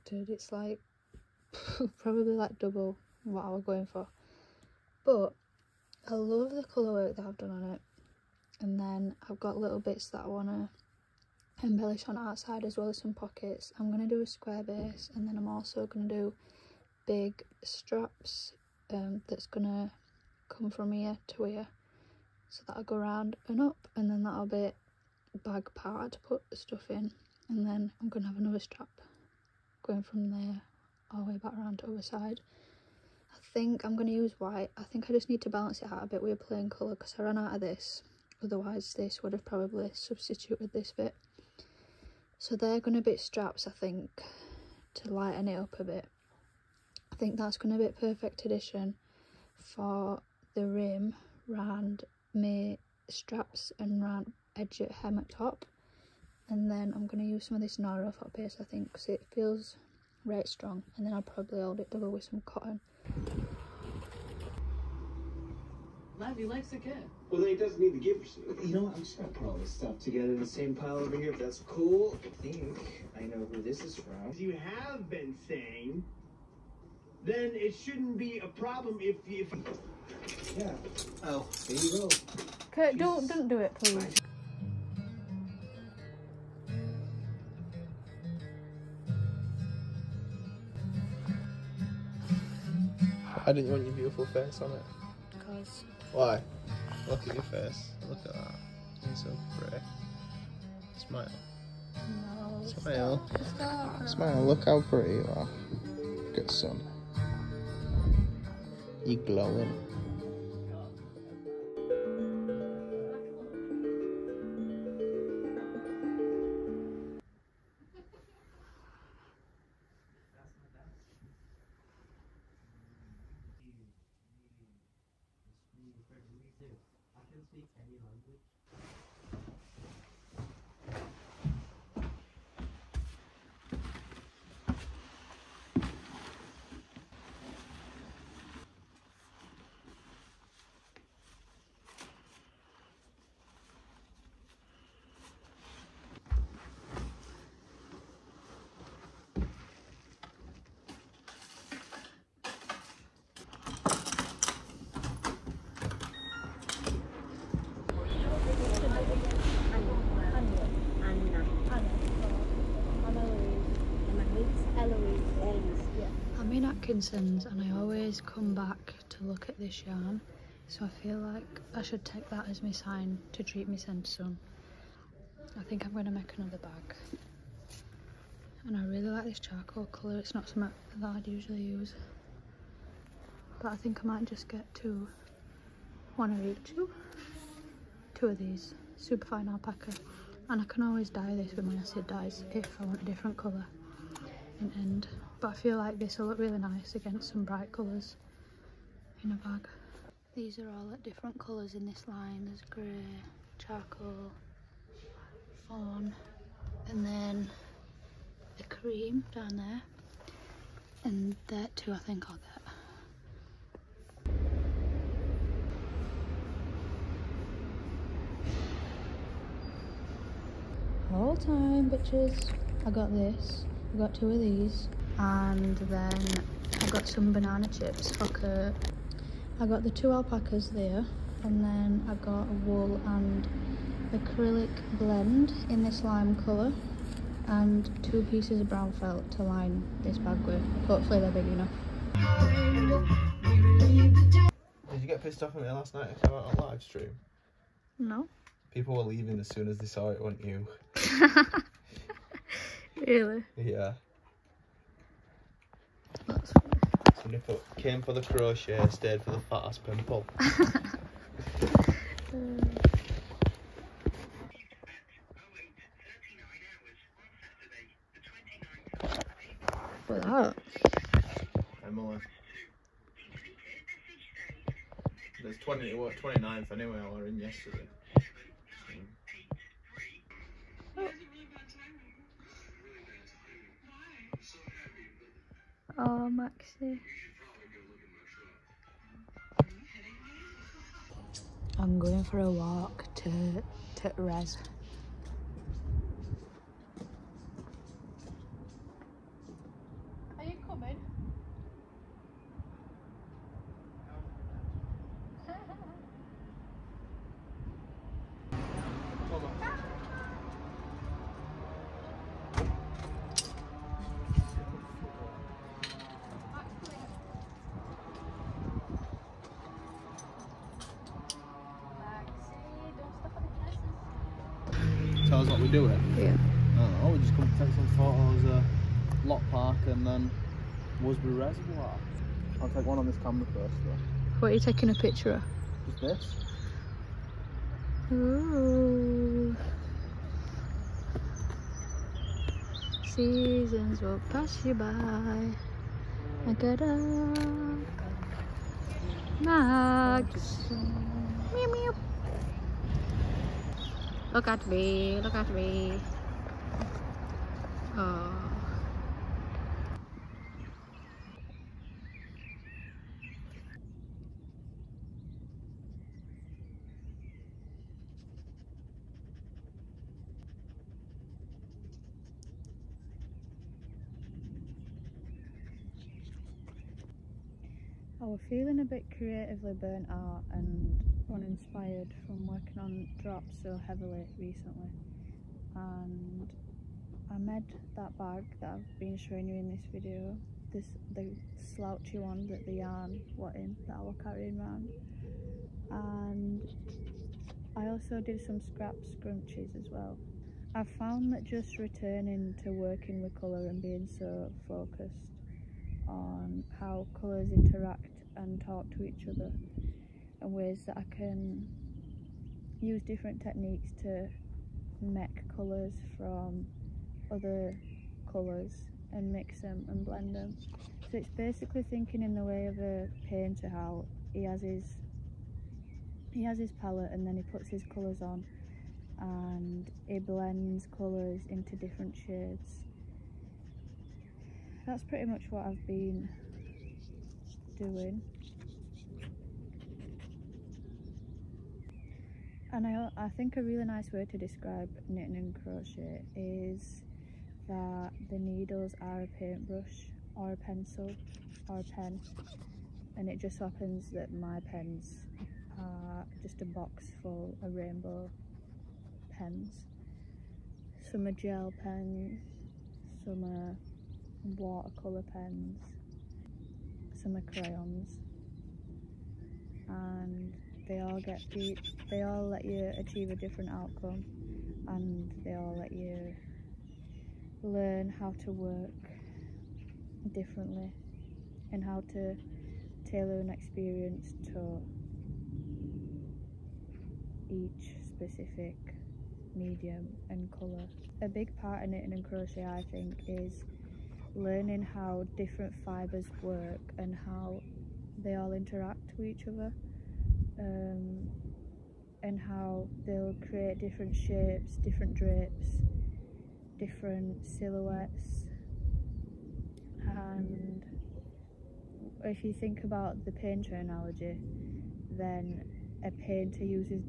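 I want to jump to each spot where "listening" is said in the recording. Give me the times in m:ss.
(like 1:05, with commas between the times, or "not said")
not said.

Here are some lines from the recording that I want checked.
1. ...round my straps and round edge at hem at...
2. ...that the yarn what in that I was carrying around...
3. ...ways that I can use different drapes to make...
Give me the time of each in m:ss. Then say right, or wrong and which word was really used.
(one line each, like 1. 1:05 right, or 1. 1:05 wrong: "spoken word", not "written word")
1. 0:51 right
2. 6:32 right
3. 6:50 wrong: "techniques", not "drapes".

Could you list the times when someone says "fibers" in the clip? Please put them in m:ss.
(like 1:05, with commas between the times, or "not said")
8:15.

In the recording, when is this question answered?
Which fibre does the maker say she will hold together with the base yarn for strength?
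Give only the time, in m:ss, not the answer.
1:02.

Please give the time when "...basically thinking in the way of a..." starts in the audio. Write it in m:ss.
7:01.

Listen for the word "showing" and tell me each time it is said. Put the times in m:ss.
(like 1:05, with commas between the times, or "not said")
6:29.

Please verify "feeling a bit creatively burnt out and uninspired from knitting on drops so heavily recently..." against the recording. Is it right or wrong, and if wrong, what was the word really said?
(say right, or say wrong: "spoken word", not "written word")
wrong: "working", not "knitting".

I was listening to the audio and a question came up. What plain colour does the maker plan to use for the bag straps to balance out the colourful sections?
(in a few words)
White.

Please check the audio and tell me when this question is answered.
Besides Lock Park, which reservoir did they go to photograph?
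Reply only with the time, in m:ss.
5:31.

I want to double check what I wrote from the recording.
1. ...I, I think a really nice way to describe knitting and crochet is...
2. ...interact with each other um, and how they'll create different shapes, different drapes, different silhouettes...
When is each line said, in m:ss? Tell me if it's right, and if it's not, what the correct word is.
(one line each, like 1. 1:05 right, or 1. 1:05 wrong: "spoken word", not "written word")
1. 7:22 right
2. 8:18 right.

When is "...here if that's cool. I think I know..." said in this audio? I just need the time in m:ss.
1:11.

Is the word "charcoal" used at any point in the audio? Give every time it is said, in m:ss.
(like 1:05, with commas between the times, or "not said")
2:59, 3:23.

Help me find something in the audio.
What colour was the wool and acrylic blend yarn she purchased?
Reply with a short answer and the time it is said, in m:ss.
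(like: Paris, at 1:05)
Lime, at 3:56.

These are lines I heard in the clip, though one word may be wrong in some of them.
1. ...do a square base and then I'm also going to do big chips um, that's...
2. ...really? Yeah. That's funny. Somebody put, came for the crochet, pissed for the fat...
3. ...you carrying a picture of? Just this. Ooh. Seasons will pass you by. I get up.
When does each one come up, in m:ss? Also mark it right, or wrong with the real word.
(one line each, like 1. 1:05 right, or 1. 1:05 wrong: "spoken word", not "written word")
1. 0:14 wrong: "straps", not "chips"
2. 4:13 wrong: "stayed", not "pissed"
3. 5:34 wrong: "taking", not "carrying".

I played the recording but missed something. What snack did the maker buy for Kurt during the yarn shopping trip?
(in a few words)
Banana chips.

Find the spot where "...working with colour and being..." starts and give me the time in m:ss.
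6:42.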